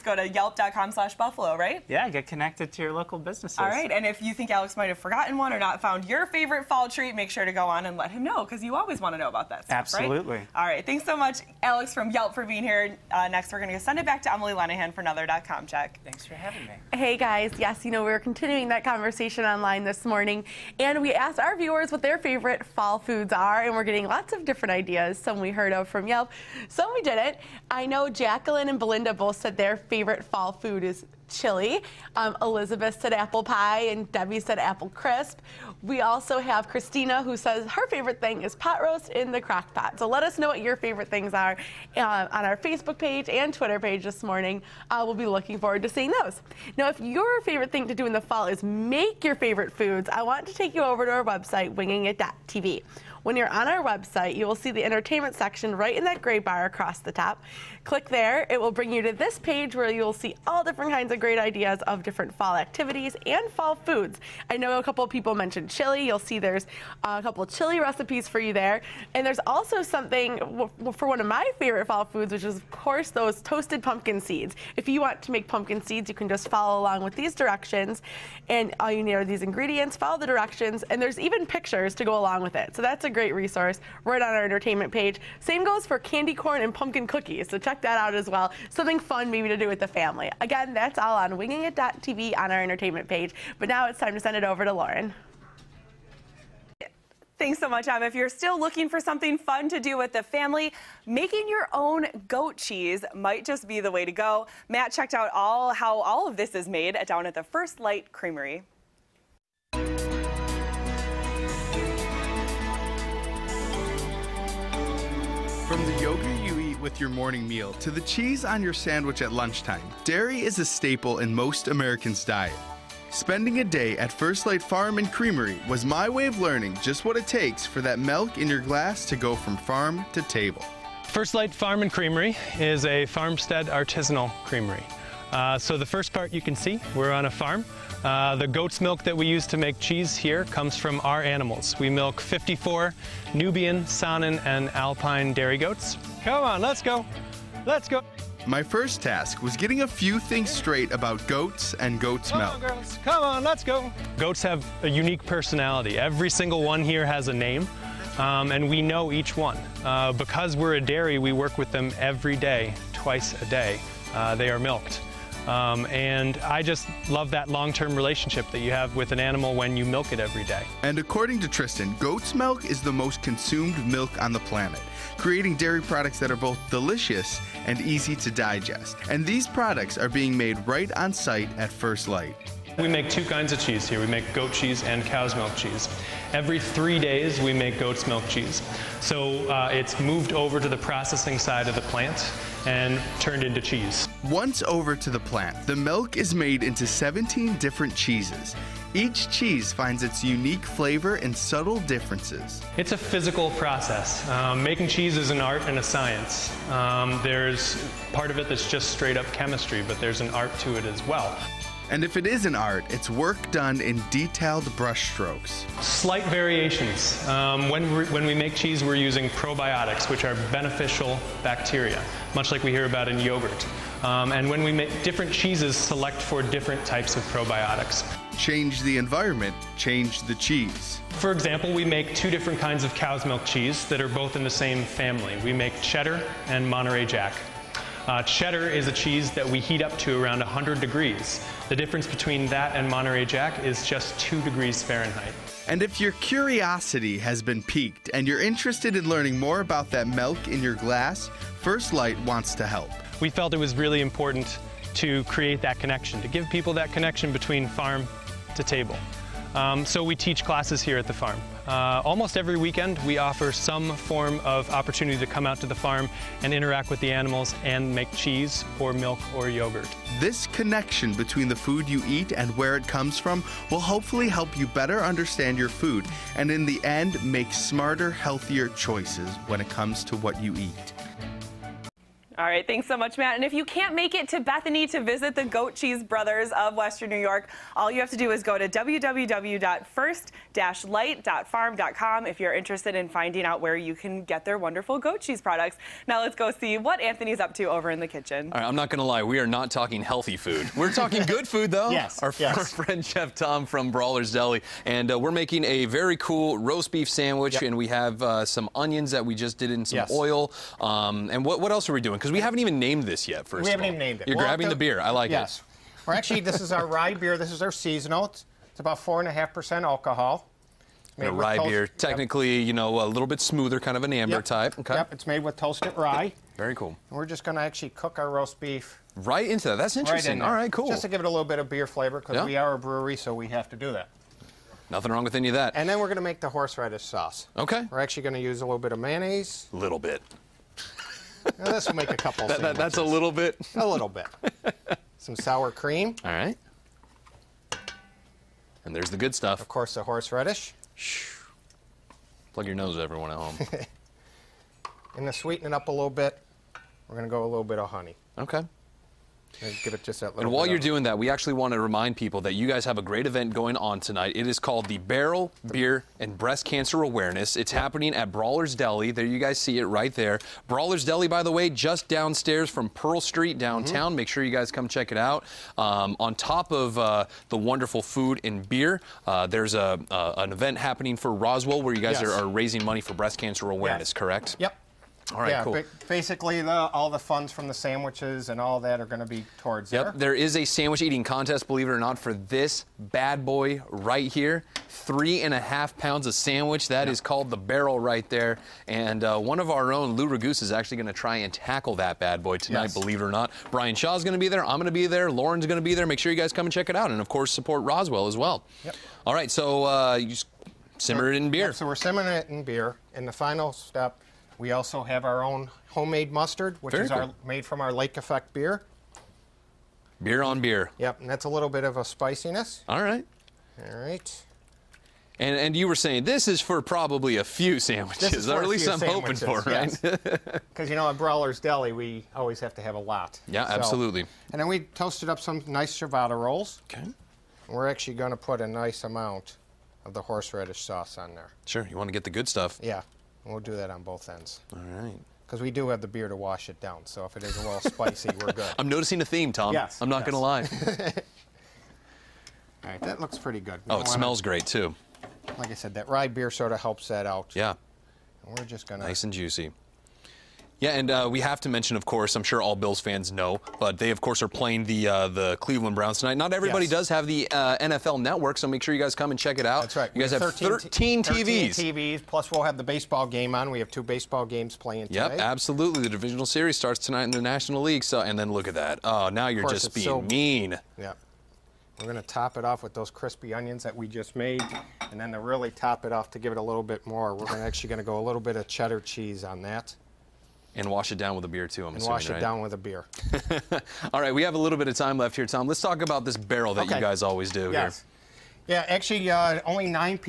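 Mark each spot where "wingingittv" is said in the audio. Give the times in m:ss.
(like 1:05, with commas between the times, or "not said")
0:51, 1:31.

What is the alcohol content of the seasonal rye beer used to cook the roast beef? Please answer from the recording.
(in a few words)
4.5%.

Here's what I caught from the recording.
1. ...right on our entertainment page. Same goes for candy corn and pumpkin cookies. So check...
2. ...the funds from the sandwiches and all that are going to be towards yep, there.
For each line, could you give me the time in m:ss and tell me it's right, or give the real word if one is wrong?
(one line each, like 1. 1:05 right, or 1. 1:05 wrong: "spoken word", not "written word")
1. 1:24 right
2. 6:27 right.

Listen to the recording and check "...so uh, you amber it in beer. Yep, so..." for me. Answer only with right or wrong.
wrong.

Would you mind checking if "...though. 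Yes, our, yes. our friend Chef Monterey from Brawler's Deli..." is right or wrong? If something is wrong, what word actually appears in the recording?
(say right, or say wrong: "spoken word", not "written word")
wrong: "Tom", not "Monterey".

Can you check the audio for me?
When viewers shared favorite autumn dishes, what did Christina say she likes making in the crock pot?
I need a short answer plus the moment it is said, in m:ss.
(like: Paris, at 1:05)
pot roast, at 0:38.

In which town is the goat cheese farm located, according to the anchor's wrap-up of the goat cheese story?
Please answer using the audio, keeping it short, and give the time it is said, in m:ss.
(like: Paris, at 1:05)
Bethany, at 4:44.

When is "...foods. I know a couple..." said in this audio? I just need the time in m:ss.
1:03.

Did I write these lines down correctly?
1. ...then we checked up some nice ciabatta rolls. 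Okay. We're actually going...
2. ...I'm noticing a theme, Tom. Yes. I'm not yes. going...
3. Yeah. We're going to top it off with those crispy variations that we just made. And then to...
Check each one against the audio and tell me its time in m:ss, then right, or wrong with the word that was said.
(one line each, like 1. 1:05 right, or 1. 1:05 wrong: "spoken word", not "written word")
1. 7:14 wrong: "toasted", not "checked"
2. 7:28 right
3. 8:00 wrong: "onions", not "variations".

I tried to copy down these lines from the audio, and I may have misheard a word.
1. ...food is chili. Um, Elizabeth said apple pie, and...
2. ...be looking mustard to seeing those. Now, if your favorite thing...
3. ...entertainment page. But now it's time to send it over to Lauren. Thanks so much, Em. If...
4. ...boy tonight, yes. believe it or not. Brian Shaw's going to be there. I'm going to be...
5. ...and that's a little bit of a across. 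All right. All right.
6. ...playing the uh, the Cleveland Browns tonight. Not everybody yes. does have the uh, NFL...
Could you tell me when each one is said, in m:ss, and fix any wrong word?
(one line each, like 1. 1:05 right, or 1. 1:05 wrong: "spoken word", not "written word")
1. 0:30 right
2. 0:45 wrong: "forward", not "mustard"
3. 1:32 right
4. 6:42 right
5. 7:01 wrong: "spiciness", not "across"
6. 7:44 right.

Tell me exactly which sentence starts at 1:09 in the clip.
And there's also something for one of my favorite fall foods, which is, of course, those toasted pumpkin seeds.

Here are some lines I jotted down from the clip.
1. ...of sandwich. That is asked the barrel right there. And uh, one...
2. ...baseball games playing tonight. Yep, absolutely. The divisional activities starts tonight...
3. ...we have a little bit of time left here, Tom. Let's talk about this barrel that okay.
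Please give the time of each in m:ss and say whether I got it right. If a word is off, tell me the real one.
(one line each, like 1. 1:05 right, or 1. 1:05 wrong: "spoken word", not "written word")
1. 6:36 wrong: "called", not "asked"
2. 7:54 wrong: "series", not "activities"
3. 8:14 right.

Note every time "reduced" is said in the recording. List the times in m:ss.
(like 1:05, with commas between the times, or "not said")
not said.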